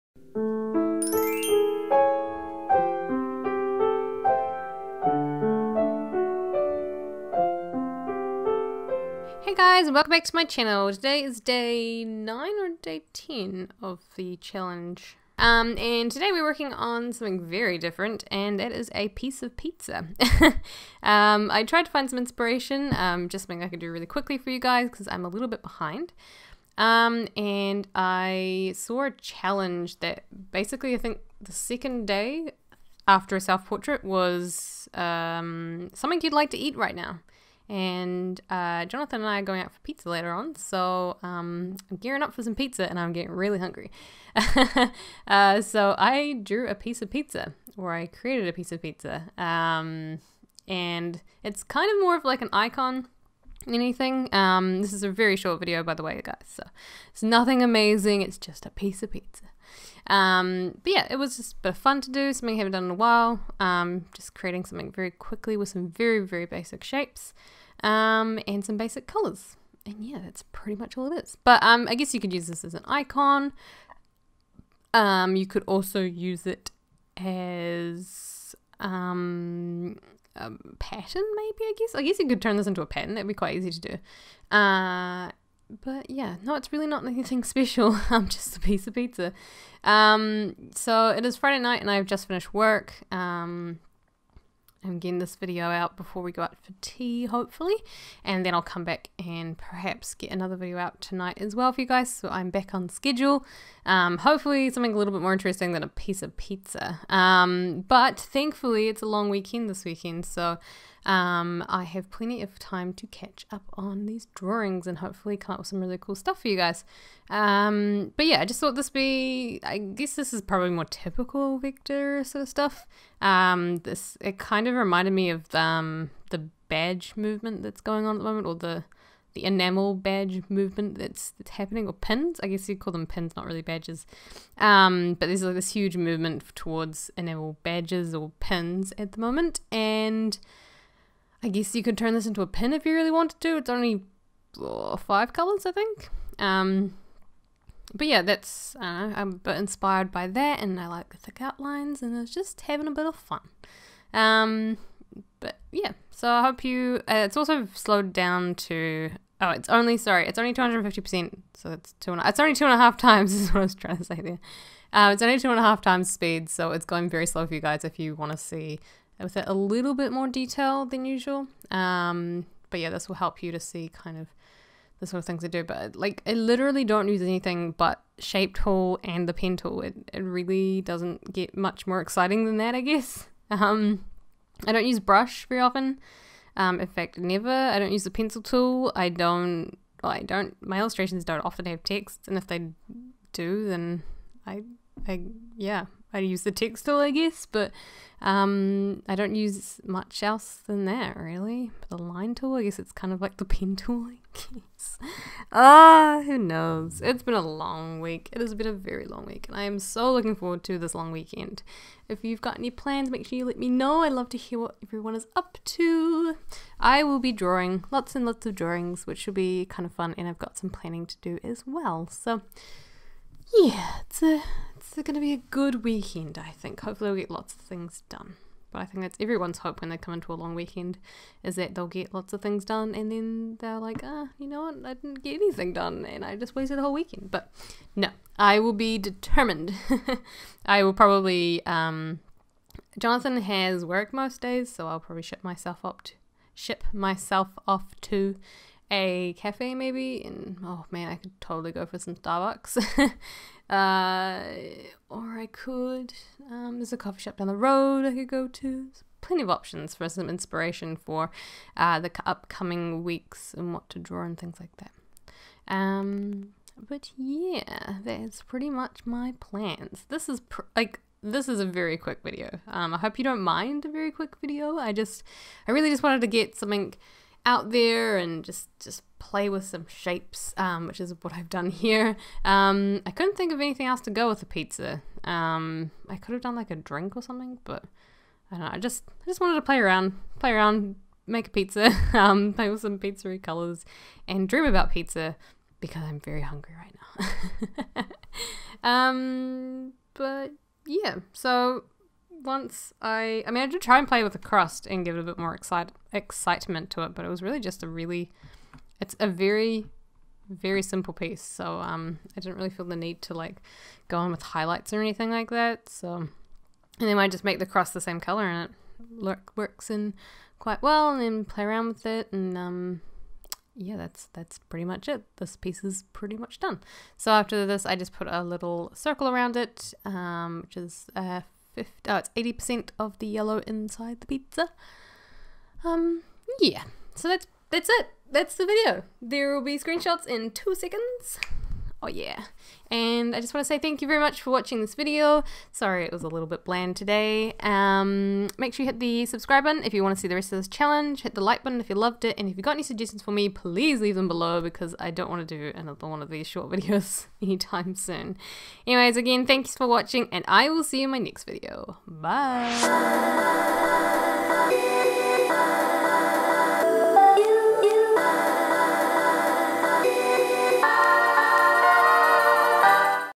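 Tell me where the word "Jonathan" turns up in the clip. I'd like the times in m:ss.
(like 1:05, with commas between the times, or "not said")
0:38, 4:02.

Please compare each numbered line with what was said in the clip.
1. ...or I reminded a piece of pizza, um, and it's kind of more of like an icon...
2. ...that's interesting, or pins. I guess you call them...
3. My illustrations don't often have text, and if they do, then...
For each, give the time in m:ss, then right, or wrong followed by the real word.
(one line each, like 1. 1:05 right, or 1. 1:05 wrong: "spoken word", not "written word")
1. 0:47 wrong: "created", not "reminded"
2. 2:11 wrong: "happening", not "interesting"
3. 3:10 right.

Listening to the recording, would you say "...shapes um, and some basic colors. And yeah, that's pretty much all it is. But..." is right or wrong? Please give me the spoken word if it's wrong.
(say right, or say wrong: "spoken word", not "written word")
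right.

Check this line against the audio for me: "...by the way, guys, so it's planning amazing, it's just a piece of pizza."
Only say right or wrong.
wrong.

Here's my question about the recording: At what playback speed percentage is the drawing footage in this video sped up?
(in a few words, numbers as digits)
250%.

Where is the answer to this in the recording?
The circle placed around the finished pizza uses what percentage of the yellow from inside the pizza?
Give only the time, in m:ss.
5:32.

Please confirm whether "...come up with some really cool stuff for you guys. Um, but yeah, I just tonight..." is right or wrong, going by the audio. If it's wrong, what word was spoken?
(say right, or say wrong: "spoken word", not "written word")
wrong: "thought", not "tonight".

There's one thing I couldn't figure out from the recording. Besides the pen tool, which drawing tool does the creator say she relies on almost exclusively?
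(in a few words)
shape tool.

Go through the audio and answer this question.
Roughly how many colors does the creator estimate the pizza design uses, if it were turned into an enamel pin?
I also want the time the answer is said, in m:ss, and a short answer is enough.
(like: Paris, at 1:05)
5, at 2:24.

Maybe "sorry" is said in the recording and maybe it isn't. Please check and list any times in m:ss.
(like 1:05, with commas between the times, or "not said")
2:39, 5:45.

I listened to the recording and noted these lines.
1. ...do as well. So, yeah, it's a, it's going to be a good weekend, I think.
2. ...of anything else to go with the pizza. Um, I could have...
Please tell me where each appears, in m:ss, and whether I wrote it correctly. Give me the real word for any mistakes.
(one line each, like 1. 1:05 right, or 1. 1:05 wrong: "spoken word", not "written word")
1. 3:41 right
2. 4:43 right.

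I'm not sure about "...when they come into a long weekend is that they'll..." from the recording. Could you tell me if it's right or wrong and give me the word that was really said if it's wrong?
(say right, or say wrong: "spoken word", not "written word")
right.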